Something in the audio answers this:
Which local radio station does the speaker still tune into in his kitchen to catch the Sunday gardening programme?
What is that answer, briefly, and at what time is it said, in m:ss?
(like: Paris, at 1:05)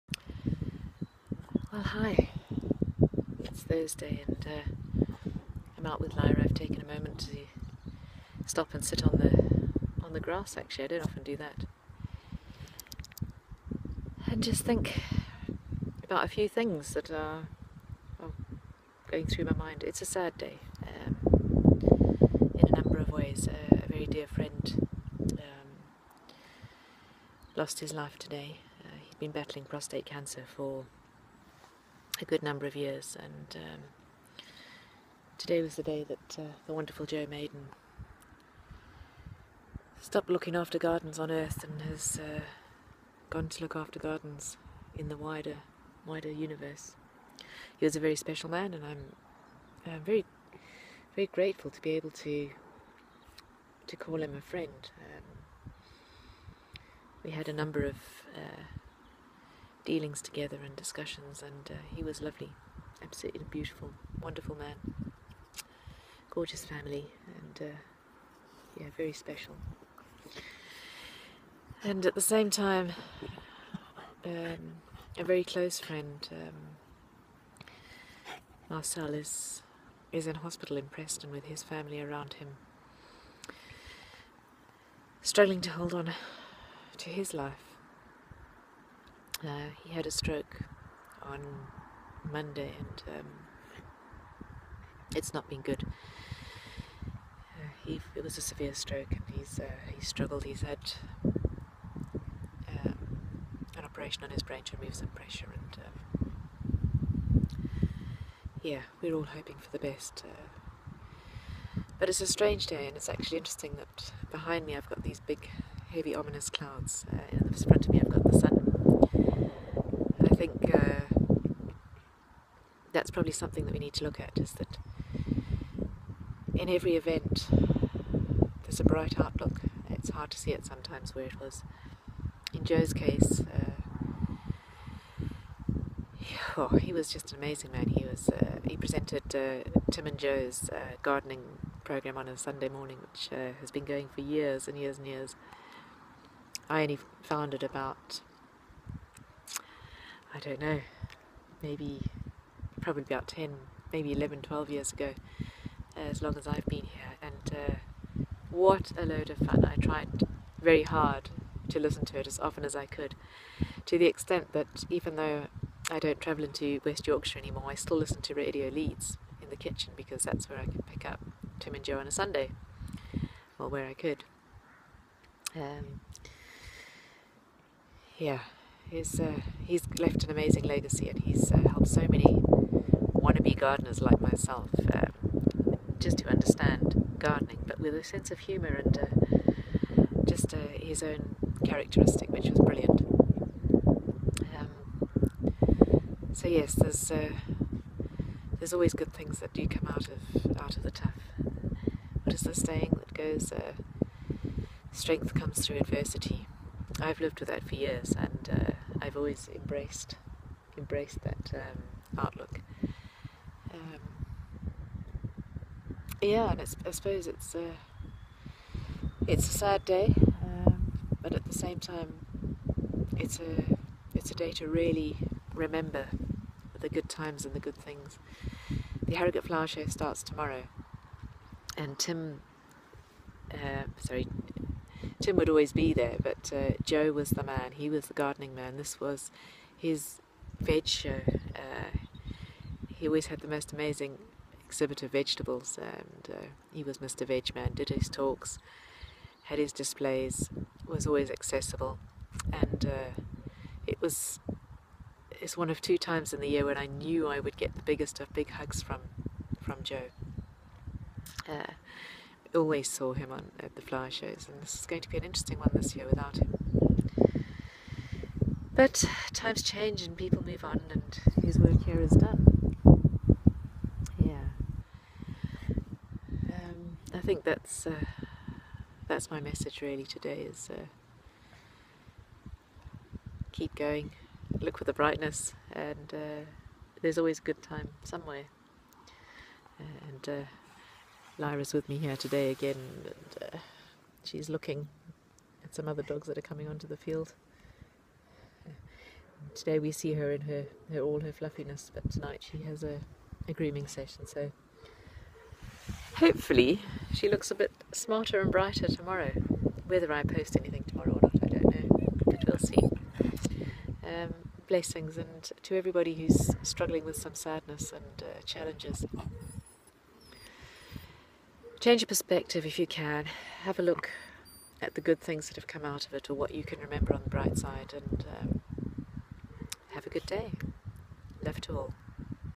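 Radio Leeds, at 2:48.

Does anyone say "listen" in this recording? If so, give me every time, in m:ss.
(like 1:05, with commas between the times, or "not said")
2:41, 2:47.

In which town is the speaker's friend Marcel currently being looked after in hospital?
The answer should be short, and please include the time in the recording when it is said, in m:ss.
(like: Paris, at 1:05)
Preston, at 1:20.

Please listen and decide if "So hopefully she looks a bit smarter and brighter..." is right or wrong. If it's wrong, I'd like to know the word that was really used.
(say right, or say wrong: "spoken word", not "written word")
right.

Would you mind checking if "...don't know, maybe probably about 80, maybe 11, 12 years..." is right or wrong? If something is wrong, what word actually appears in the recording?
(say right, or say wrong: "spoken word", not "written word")
wrong: "10", not "80".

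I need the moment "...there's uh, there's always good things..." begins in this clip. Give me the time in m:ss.
3:16.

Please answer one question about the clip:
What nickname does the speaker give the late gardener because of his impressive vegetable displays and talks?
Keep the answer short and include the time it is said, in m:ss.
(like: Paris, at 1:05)
Mr. Vegman, at 4:06.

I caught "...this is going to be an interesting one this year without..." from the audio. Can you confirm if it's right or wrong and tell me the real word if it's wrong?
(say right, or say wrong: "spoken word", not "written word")
right.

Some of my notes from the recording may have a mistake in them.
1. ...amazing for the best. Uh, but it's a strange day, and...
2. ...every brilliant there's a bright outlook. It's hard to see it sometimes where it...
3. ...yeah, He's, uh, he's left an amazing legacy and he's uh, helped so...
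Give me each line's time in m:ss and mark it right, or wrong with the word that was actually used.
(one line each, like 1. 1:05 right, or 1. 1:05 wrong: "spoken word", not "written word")
1. 1:49 wrong: "hoping", not "amazing"
2. 2:06 wrong: "event", not "brilliant"
3. 2:58 right.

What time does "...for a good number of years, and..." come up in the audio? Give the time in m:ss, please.
0:30.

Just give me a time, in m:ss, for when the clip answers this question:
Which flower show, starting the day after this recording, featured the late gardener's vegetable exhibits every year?
3:49.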